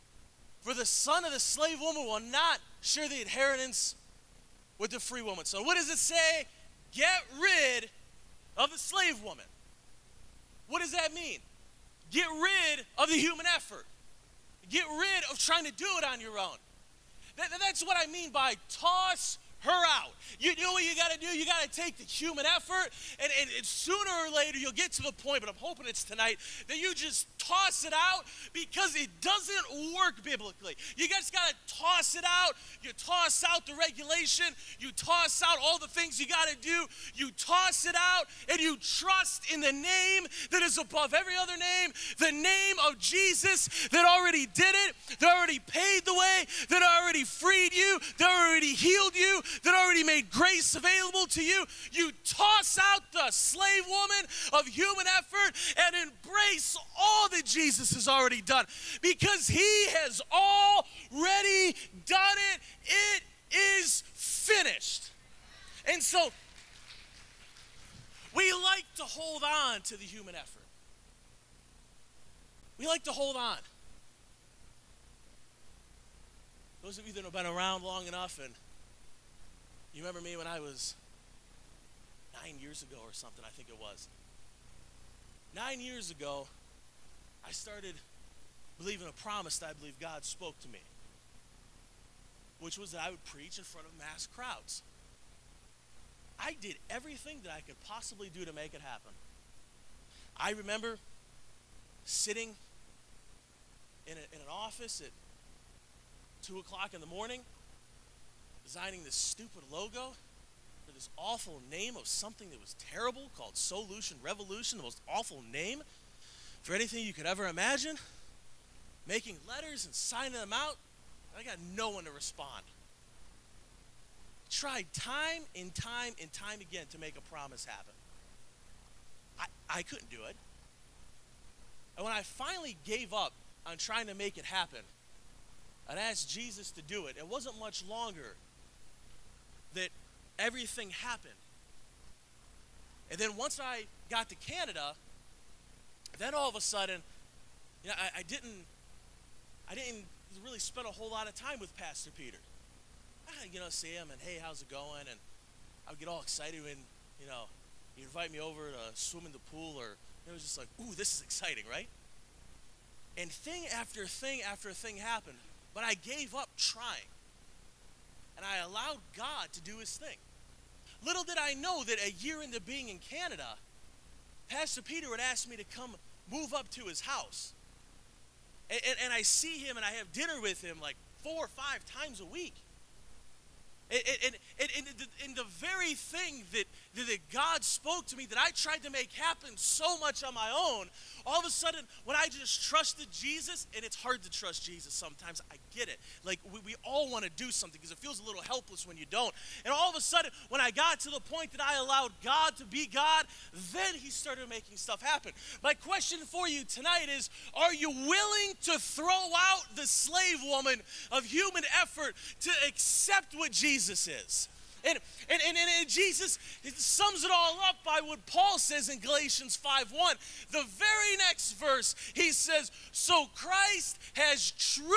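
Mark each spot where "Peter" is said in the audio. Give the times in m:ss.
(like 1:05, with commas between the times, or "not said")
2:32, 2:54.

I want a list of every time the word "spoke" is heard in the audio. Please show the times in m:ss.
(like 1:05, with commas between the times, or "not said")
1:30, 3:07.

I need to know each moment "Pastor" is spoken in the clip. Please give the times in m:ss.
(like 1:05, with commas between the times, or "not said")
2:31, 2:54.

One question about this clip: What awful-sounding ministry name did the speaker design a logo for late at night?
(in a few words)
Solution Revolution.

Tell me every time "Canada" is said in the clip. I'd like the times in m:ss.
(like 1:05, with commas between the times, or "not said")
2:24, 2:52.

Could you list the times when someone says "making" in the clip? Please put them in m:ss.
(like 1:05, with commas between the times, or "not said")
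1:59, 3:24.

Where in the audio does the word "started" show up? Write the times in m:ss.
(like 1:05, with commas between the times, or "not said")
1:27, 3:24.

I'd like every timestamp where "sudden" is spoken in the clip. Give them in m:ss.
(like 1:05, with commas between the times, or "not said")
2:26, 3:11, 3:20.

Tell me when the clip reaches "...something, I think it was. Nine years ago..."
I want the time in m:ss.
1:23.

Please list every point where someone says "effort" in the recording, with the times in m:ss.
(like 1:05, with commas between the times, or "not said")
0:13, 0:22, 0:55, 1:10, 3:31.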